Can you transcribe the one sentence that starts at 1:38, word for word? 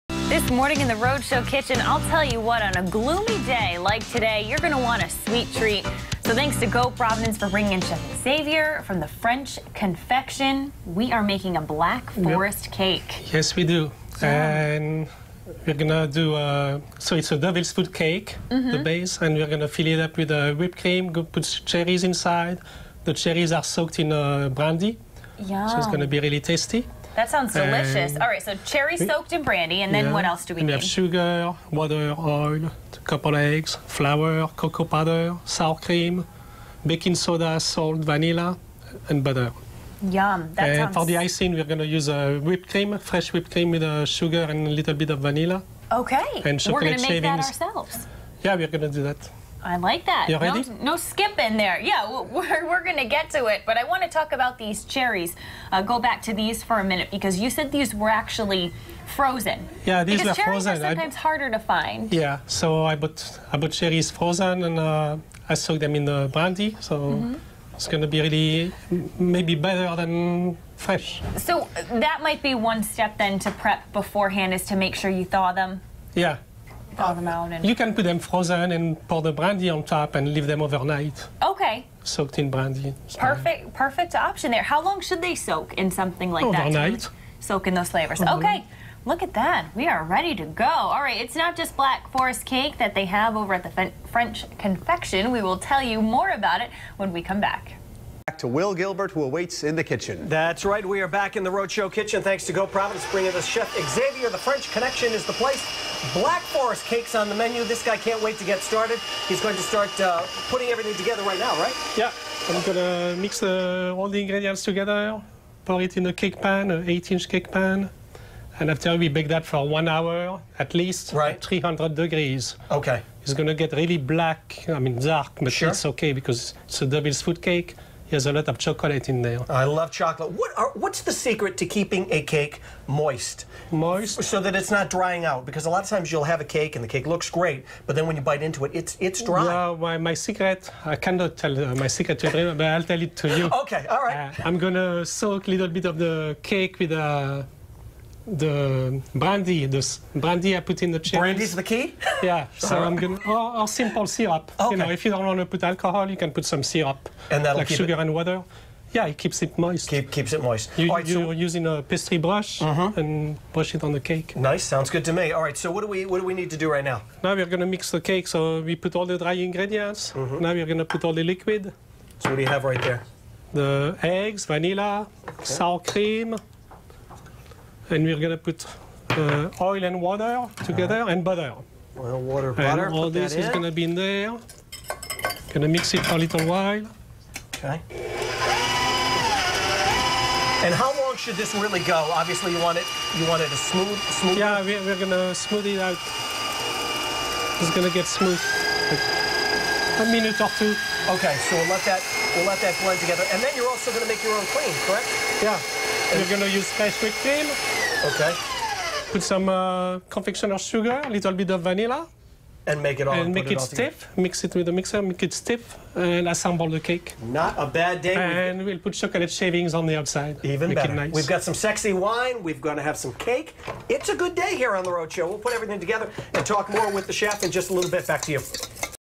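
Back to Will Gilbert, who awaits in the kitchen.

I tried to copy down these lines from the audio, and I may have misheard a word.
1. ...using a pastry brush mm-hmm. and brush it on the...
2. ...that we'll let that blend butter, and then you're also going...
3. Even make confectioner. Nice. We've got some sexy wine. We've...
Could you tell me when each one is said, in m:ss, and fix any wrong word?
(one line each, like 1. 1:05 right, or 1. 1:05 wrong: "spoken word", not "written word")
1. 2:41 right
2. 3:21 wrong: "together", not "butter"
3. 3:40 wrong: "better", not "confectioner".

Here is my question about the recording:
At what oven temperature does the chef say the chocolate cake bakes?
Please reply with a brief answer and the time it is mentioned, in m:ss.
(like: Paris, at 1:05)
300 degrees, at 2:01.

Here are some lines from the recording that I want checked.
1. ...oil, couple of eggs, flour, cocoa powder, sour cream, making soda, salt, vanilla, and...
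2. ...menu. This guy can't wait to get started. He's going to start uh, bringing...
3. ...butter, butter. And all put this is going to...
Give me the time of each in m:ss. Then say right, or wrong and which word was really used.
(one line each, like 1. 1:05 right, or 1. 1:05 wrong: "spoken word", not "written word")
1. 0:32 wrong: "baking", not "making"
2. 1:47 wrong: "putting", not "bringing"
3. 3:02 wrong: "water", not "butter".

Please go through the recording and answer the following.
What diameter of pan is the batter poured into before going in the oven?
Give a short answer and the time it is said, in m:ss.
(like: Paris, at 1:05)
8-inch, at 1:56.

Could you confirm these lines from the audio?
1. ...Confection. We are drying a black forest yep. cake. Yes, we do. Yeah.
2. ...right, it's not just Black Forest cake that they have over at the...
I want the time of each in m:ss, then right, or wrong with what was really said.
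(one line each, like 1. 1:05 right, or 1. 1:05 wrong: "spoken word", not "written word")
1. 0:09 wrong: "making", not "drying"
2. 1:31 right.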